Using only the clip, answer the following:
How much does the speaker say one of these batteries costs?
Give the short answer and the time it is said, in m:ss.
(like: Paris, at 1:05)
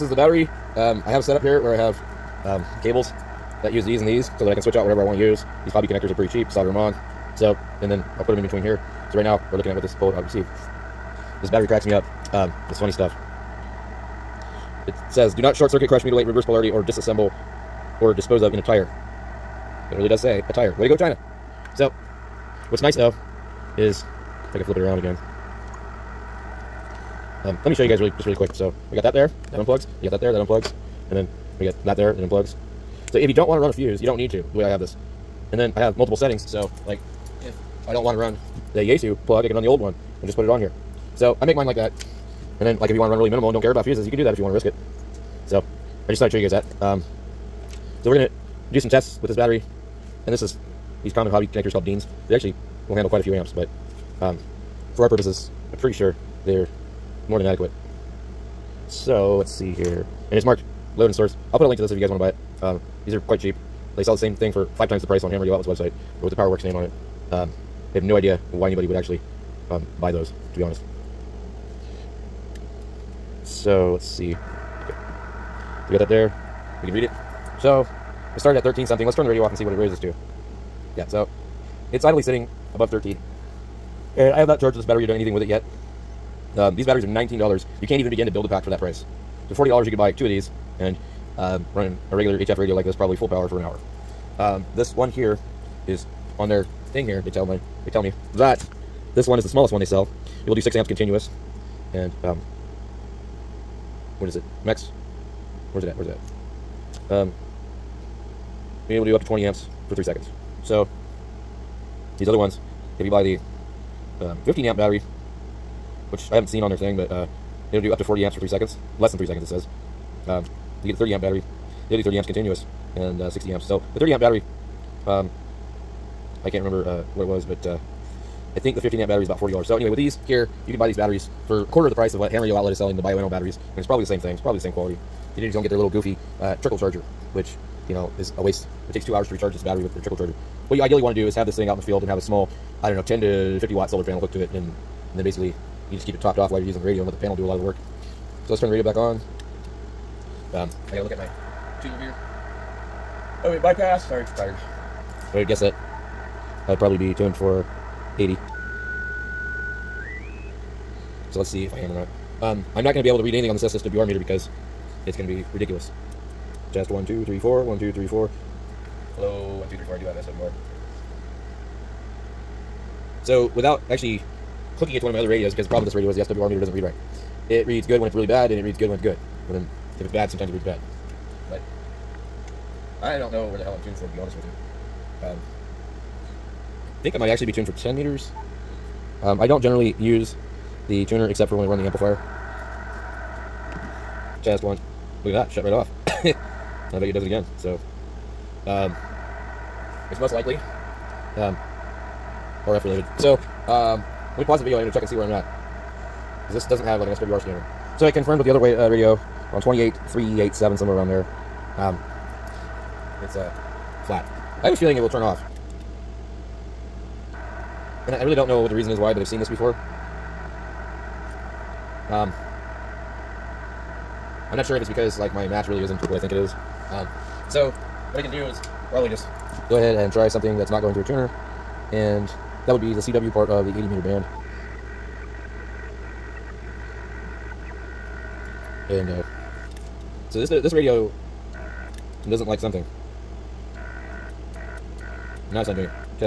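$19, at 1:27.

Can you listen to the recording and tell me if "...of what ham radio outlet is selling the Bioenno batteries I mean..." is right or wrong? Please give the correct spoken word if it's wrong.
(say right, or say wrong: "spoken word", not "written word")
right.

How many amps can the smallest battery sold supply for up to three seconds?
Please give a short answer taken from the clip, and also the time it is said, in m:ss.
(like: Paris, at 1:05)
20 amps, at 1:49.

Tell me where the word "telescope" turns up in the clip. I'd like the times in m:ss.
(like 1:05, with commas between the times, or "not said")
not said.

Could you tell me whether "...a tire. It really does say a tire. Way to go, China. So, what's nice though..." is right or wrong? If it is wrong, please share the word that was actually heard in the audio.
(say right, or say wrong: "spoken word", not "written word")
right.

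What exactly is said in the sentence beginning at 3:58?
And uh, so this this radio doesn't like something.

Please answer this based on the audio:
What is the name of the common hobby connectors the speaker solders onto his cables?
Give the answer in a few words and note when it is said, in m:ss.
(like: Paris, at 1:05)
Deans, at 0:51.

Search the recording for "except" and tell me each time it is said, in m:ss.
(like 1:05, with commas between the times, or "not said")
3:11.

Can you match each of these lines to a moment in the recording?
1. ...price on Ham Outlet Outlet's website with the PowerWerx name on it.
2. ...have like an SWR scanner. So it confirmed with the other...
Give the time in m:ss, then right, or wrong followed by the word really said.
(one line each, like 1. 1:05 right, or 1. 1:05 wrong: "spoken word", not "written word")
1. 1:05 wrong: "Radio", not "Outlet"
2. 3:26 right.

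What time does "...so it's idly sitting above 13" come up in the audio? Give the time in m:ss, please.
1:21.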